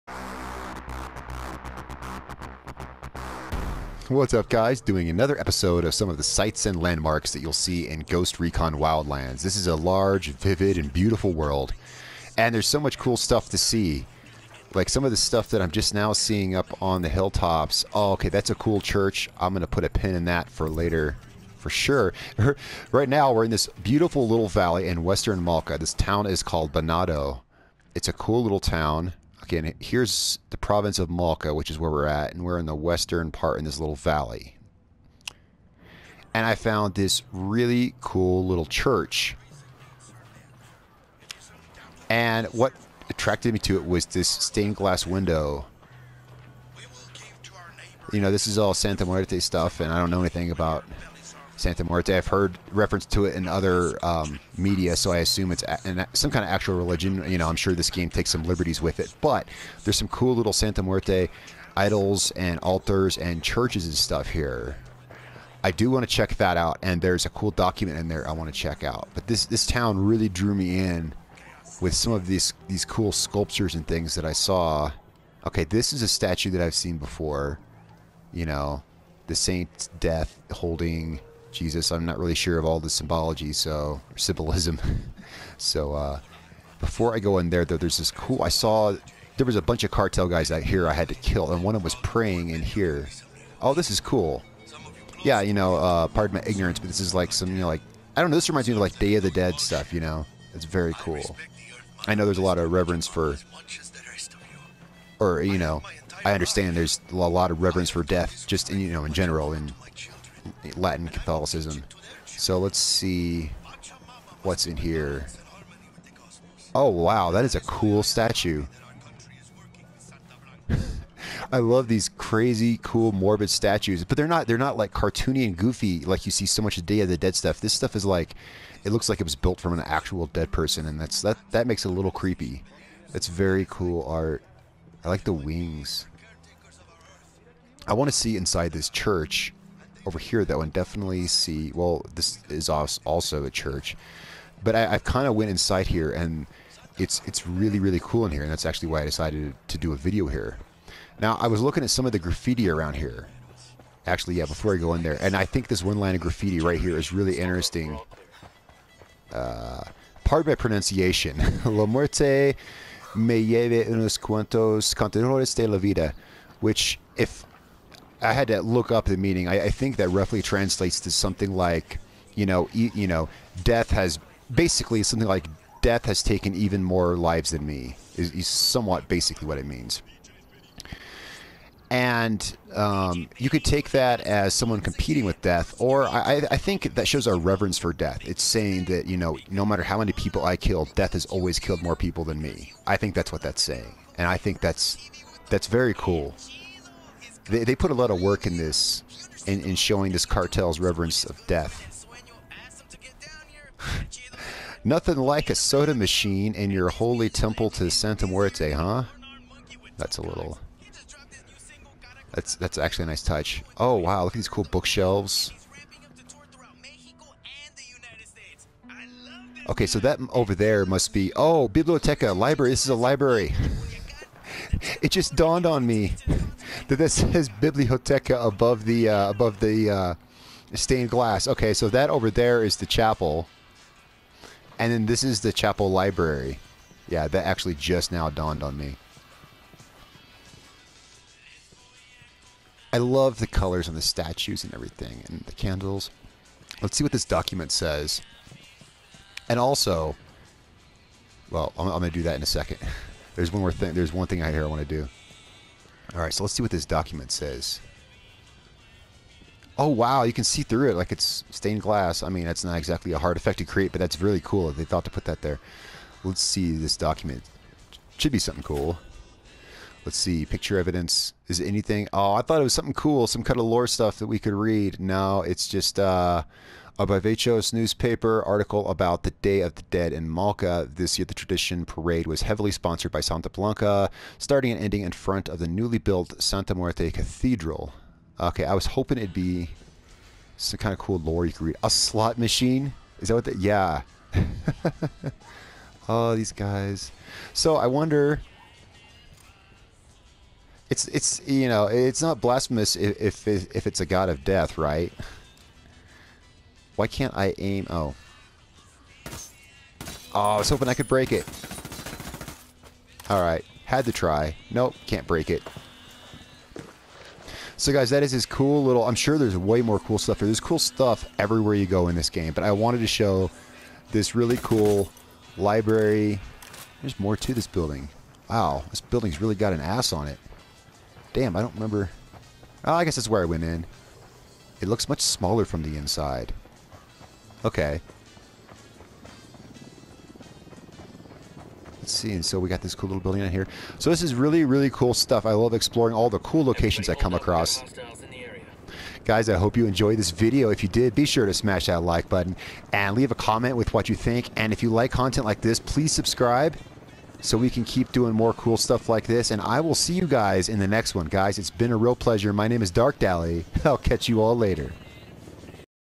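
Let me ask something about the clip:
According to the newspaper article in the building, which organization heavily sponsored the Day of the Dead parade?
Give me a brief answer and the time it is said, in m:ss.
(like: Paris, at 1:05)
Santa Blanca, at 4:43.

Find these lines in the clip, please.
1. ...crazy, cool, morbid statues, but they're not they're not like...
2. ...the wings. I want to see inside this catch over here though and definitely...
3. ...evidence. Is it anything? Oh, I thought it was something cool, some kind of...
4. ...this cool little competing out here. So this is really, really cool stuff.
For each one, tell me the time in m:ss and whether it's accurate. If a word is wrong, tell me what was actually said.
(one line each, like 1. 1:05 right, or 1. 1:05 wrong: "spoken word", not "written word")
1. 2:02 right
2. 2:15 wrong: "church", not "catch"
3. 4:30 right
4. 5:42 wrong: "building", not "competing".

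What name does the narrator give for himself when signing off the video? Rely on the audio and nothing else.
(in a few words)
Dark Dally.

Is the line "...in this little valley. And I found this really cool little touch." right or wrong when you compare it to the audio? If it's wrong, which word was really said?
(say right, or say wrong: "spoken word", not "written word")
wrong: "church", not "touch".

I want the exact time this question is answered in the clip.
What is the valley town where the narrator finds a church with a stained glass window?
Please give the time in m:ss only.
0:26.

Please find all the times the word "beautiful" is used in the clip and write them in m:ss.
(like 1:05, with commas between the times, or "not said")
0:10, 0:23.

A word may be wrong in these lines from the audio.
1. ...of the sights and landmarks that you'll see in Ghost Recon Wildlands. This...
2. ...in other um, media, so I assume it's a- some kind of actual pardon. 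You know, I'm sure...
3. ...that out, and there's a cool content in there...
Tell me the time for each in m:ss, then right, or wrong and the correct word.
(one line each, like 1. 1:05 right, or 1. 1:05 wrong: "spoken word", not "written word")
1. 0:06 right
2. 0:53 wrong: "religion", not "pardon"
3. 1:06 wrong: "document", not "content".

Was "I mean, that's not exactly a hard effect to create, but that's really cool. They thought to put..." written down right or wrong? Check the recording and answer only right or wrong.
right.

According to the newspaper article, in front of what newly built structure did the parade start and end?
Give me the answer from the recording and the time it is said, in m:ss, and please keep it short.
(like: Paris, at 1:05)
Santa Muerte Cathedral, at 4:46.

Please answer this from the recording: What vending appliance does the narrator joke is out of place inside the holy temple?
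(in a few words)
soda machine.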